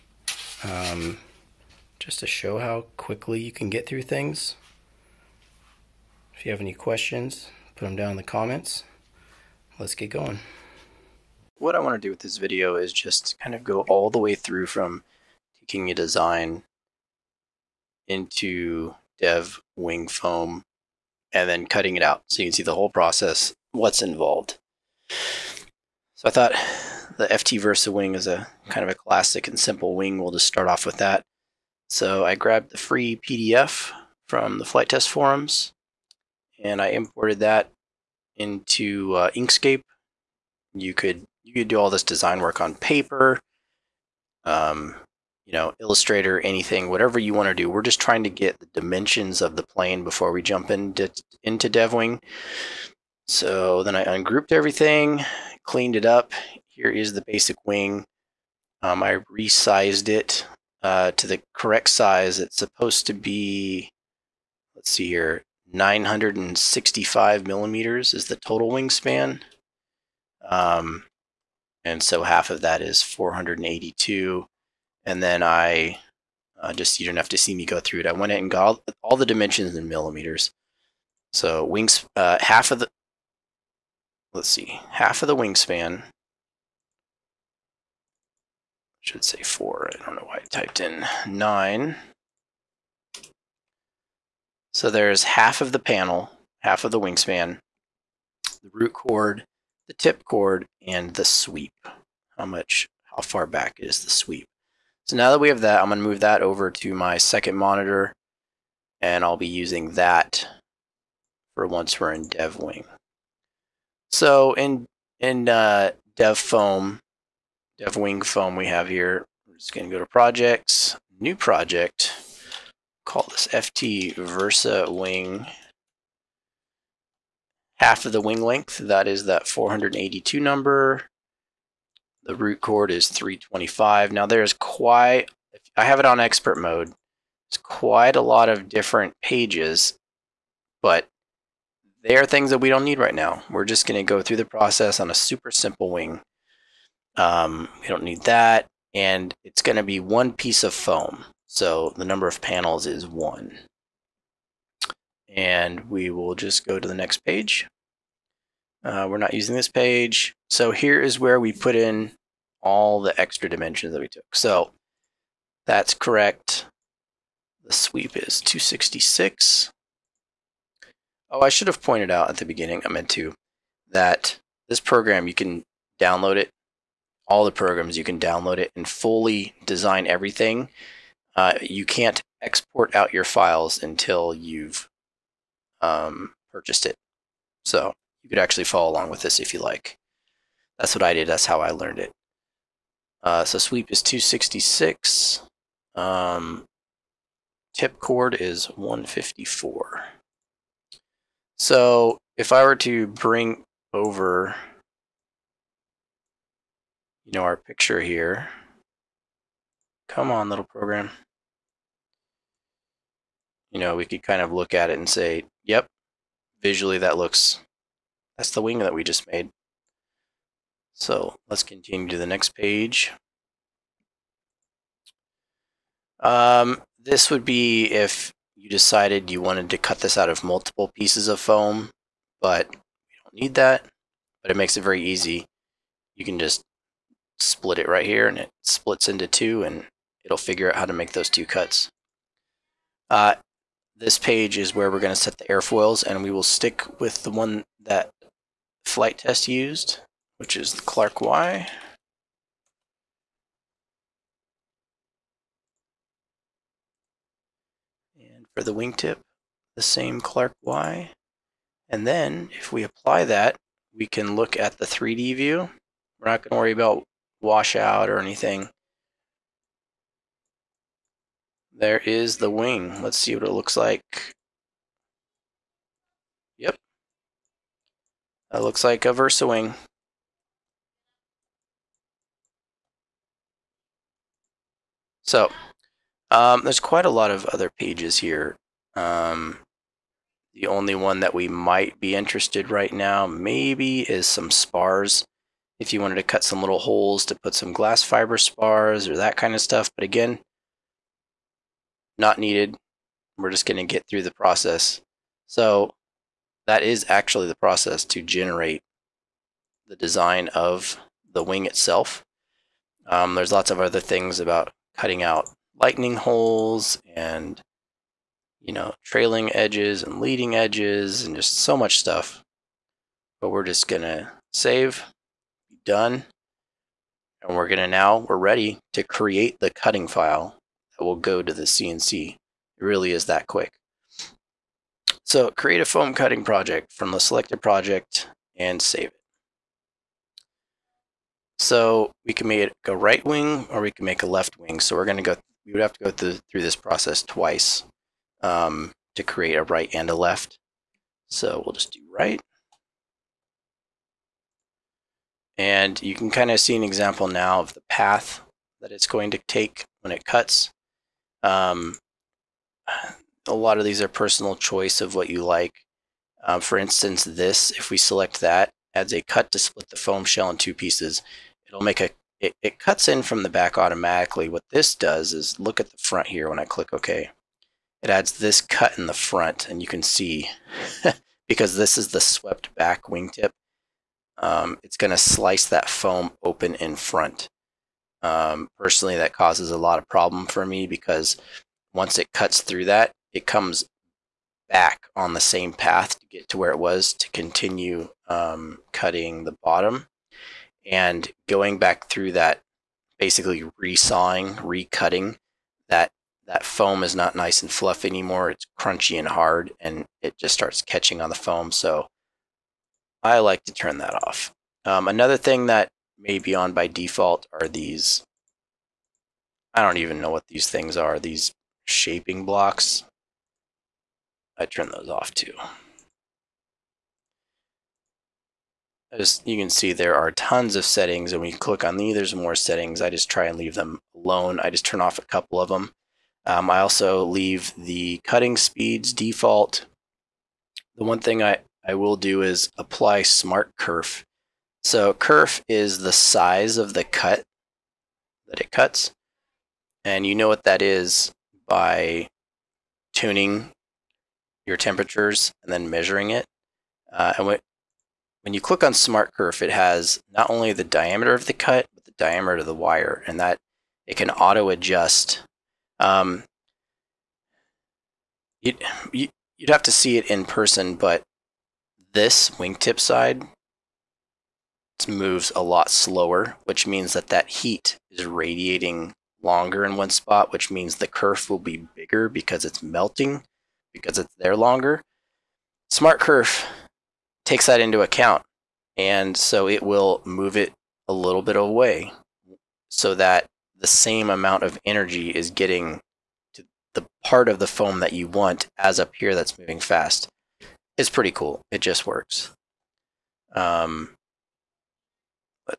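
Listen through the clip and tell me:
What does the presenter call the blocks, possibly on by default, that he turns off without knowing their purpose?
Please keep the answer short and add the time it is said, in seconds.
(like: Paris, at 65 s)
shaping blocks, at 421 s.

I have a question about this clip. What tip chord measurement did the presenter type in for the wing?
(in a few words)
154.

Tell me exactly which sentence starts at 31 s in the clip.
So I grabbed the free PDF from the Flite Test forums and I imported that into uh, Inkscape.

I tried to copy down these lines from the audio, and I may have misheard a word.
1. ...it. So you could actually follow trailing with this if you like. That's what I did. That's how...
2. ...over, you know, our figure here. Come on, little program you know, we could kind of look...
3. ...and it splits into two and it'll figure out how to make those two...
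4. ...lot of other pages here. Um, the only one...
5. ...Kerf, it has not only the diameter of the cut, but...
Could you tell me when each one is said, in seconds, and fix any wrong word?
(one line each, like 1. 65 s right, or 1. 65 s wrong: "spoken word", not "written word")
1. 186 s wrong: "along", not "trailing"
2. 203 s wrong: "picture", not "figure"
3. 238 s right
4. 287 s right
5. 459 s right.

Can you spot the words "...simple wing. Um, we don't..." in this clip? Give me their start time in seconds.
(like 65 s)
145 s.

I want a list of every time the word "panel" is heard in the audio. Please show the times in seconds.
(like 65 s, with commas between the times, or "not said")
95 s, 152 s.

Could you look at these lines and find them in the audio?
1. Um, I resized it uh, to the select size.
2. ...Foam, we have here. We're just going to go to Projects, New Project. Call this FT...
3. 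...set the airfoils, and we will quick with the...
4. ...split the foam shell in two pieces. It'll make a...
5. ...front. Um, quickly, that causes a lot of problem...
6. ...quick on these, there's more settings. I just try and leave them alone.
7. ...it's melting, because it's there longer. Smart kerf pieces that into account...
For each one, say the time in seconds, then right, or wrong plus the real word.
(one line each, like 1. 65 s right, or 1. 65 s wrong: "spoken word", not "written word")
1. 58 s wrong: "correct", not "select"
2. 118 s right
3. 245 s wrong: "stick", not "quick"
4. 369 s right
5. 386 s wrong: "personally", not "quickly"
6. 431 s wrong: "click", not "quick"
7. 482 s wrong: "takes", not "pieces".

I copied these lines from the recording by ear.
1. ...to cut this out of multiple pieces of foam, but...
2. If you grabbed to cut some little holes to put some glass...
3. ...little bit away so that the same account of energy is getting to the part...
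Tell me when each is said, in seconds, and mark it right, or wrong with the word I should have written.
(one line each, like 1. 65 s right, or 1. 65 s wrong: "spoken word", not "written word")
1. 229 s right
2. 295 s wrong: "wanted", not "grabbed"
3. 491 s wrong: "amount", not "account".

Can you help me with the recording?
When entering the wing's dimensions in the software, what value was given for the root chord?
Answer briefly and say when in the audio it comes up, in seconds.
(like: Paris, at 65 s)
325, at 133 s.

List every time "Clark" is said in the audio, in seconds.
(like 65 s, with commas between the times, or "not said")
250 s, 260 s.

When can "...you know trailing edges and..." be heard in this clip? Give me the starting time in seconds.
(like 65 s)
318 s.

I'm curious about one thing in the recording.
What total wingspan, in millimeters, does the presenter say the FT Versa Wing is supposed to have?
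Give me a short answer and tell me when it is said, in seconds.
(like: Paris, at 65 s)
965, at 65 s.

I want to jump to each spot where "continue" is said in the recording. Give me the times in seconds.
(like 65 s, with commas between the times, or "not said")
221 s, 397 s.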